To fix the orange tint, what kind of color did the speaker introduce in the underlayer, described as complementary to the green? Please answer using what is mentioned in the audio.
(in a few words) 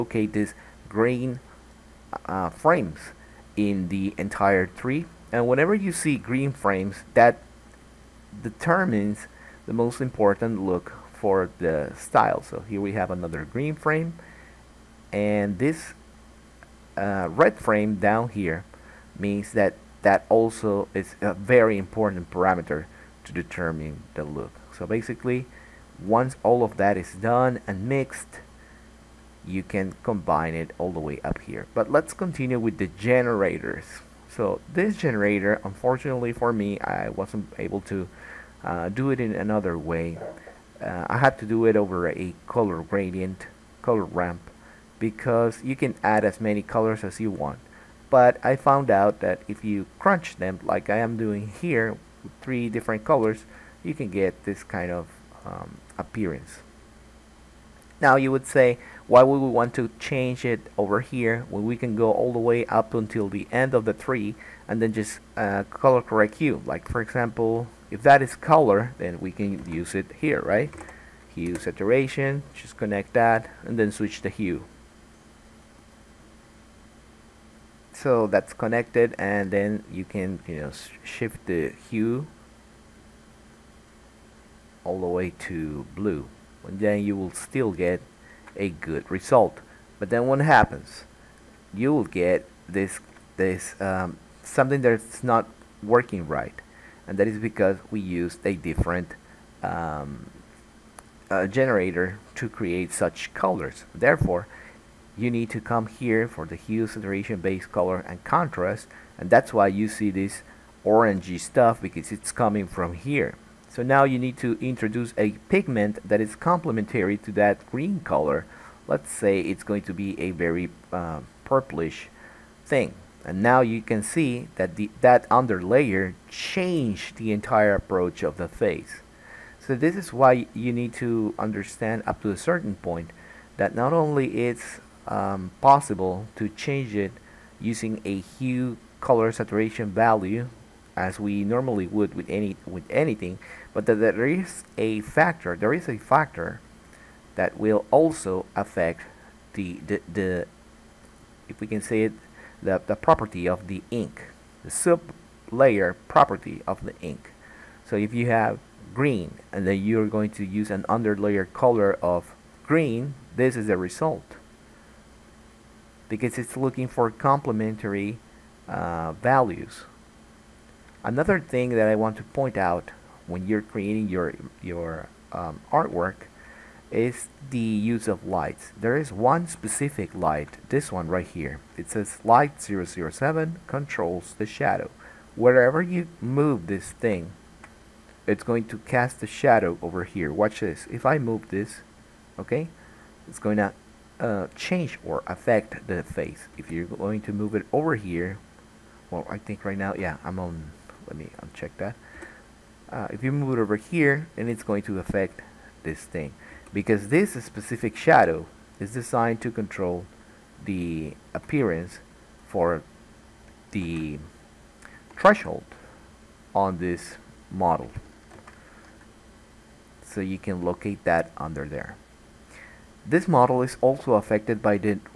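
purplish.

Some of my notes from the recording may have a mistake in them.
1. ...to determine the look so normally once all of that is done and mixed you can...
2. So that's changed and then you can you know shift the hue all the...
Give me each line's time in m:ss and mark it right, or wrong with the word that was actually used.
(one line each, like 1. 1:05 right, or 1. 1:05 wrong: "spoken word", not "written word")
1. 0:23 wrong: "basically", not "normally"
2. 1:17 wrong: "connected", not "changed".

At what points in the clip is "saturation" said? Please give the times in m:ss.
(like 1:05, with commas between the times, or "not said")
1:11, 1:46, 2:19.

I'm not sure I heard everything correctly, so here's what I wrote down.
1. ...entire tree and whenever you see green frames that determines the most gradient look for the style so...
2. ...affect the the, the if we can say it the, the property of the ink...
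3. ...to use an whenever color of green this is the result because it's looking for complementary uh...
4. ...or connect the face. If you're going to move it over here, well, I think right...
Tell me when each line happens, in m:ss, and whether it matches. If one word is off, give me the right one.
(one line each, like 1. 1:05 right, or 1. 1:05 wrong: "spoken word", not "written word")
1. 0:04 wrong: "important", not "gradient"
2. 2:28 right
3. 2:40 wrong: "underlayer", not "whenever"
4. 3:15 wrong: "affect", not "connect".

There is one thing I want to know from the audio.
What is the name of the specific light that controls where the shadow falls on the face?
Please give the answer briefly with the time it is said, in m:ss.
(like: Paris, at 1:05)
light 007, at 3:02.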